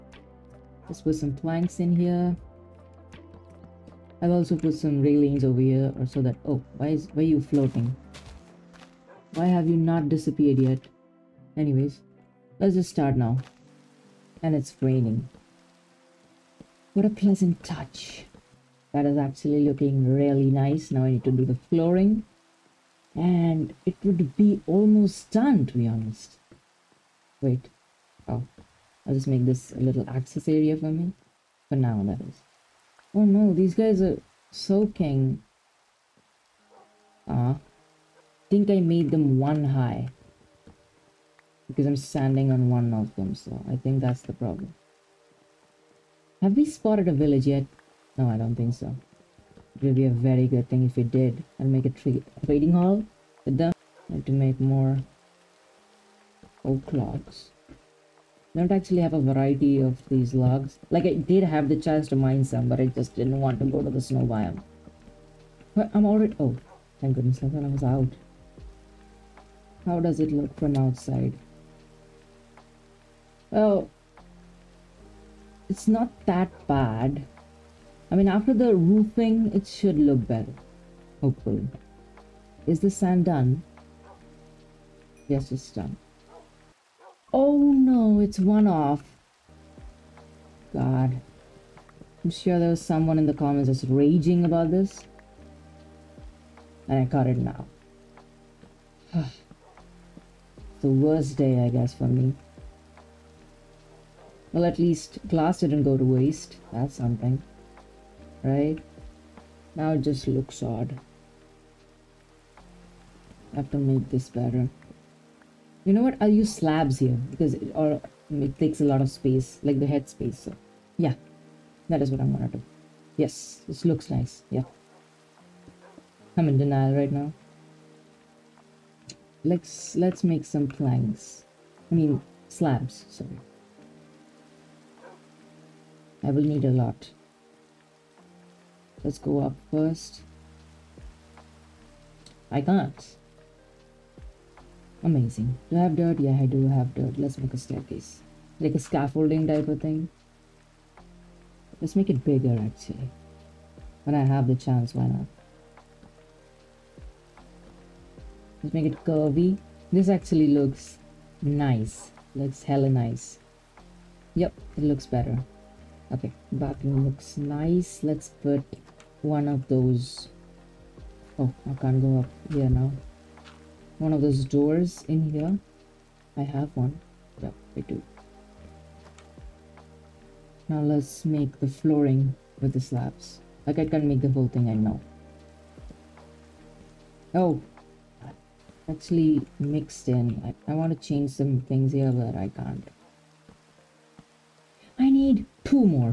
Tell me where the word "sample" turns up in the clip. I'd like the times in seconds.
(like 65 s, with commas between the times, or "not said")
not said.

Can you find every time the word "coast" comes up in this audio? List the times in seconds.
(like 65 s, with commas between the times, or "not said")
not said.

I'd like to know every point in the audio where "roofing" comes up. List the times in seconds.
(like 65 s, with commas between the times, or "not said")
78 s.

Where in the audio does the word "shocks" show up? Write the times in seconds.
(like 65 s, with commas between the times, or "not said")
not said.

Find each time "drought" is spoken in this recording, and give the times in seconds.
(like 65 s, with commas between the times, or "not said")
not said.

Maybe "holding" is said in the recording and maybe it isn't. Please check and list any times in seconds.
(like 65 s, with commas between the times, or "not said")
not said.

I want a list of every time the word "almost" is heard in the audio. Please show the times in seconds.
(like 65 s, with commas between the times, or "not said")
24 s.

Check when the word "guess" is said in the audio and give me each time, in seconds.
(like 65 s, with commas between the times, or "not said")
101 s.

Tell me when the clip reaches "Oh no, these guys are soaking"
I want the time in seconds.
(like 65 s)
33 s.